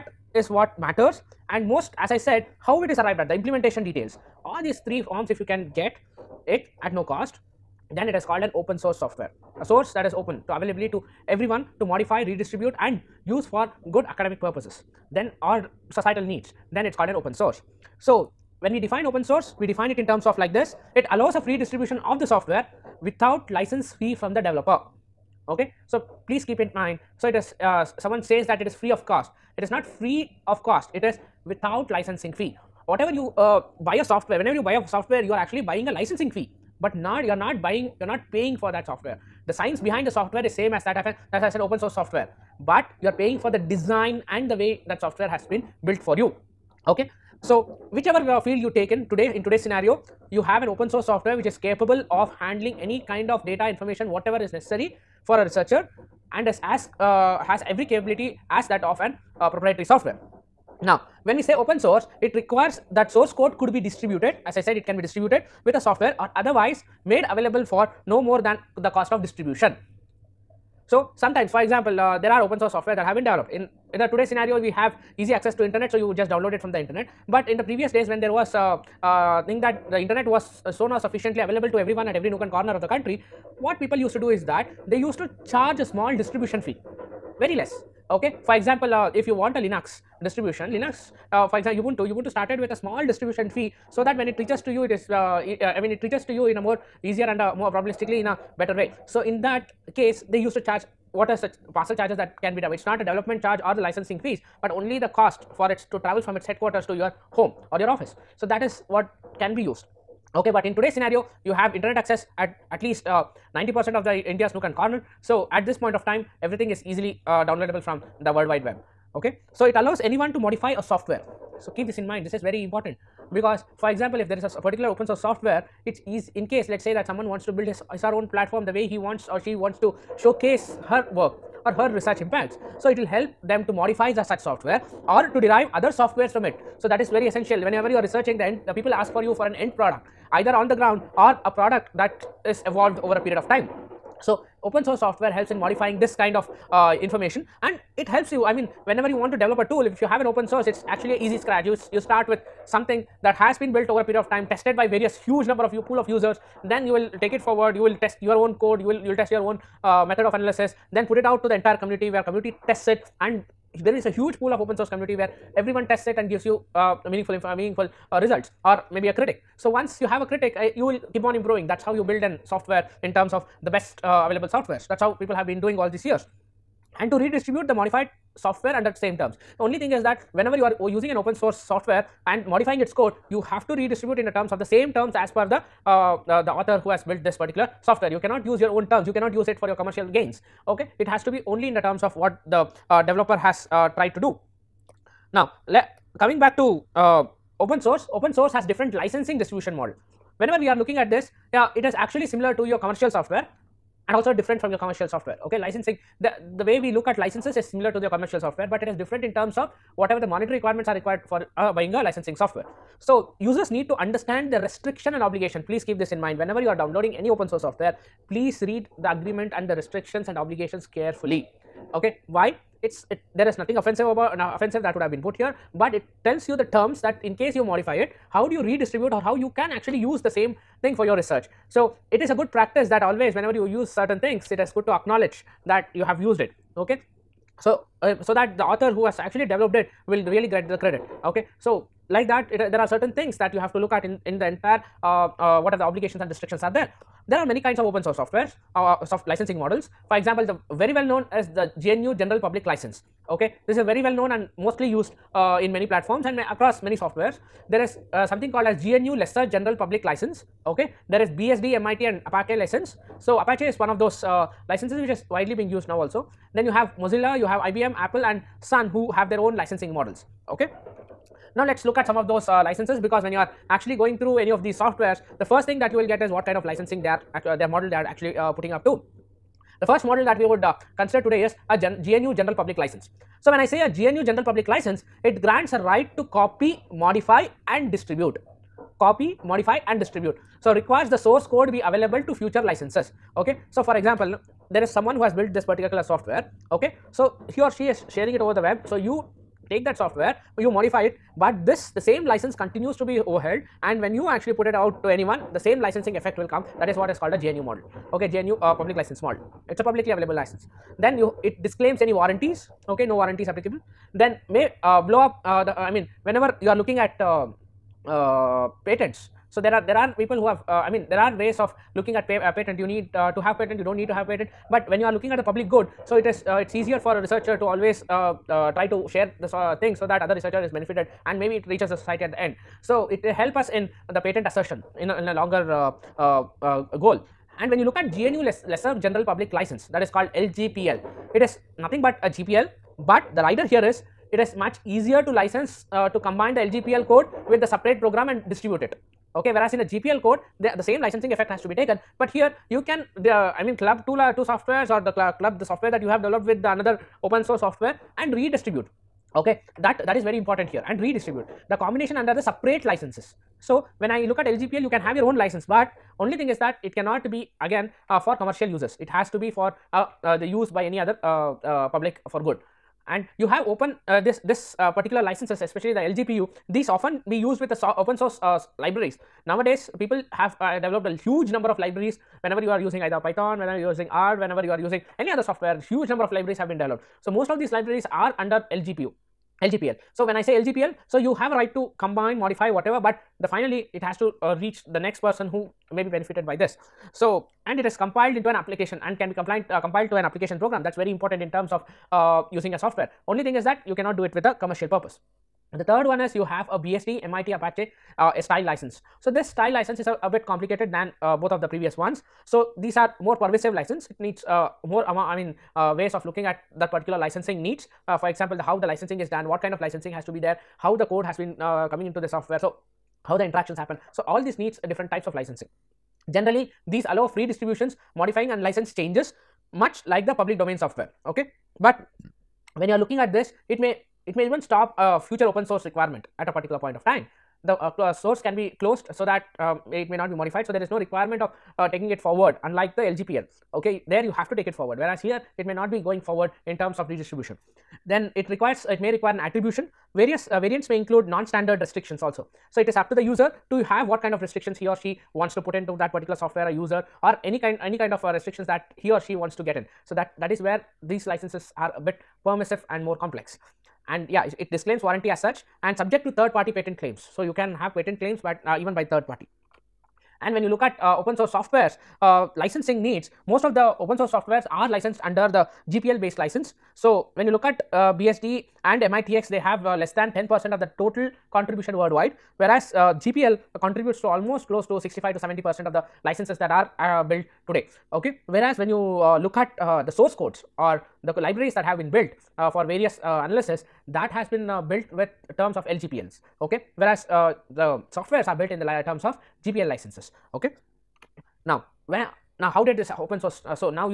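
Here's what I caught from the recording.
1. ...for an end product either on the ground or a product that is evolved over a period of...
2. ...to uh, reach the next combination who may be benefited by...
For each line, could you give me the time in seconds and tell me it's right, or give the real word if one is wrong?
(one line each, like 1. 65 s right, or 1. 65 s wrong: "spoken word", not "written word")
1. 139 s right
2. 394 s wrong: "person", not "combination".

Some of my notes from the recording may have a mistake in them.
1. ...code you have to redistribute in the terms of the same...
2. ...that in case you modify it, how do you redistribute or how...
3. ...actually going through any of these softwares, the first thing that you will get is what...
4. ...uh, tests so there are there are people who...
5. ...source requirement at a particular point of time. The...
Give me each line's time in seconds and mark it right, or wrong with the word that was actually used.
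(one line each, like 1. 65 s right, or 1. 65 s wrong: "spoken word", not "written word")
1. 182 s right
2. 227 s right
3. 273 s right
4. 318 s wrong: "patents", not "tests"
5. 435 s right.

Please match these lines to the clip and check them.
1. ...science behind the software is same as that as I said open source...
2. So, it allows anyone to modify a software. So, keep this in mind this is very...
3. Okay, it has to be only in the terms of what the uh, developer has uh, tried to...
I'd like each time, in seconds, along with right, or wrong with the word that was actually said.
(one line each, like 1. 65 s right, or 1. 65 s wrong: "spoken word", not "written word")
1. 39 s right
2. 119 s right
3. 190 s right.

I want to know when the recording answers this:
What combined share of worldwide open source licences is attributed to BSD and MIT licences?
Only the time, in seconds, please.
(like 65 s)
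479 s.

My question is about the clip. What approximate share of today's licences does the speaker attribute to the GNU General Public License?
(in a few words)
65 to 70 percent.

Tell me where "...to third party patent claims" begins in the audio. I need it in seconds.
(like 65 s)
466 s.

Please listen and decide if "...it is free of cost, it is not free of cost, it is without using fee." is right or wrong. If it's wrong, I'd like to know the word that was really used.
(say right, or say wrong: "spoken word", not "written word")
wrong: "licensing", not "using".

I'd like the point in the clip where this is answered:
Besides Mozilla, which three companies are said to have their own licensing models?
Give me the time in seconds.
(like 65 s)
267 s.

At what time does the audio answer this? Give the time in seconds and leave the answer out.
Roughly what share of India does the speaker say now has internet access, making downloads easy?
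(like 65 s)
113 s.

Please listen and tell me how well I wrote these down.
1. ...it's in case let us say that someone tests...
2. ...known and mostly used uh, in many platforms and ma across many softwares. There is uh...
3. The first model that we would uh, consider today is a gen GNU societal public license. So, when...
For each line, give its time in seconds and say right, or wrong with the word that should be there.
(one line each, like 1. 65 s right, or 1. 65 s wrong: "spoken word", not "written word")
1. 125 s wrong: "wants", not "tests"
2. 254 s right
3. 279 s wrong: "general", not "societal".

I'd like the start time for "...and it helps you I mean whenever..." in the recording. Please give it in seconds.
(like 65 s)
147 s.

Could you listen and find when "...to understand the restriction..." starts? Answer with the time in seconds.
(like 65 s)
213 s.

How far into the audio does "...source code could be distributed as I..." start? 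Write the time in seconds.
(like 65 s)
63 s.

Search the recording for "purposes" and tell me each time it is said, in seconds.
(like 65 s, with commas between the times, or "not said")
14 s, 404 s.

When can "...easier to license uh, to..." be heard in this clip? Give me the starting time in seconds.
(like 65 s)
344 s.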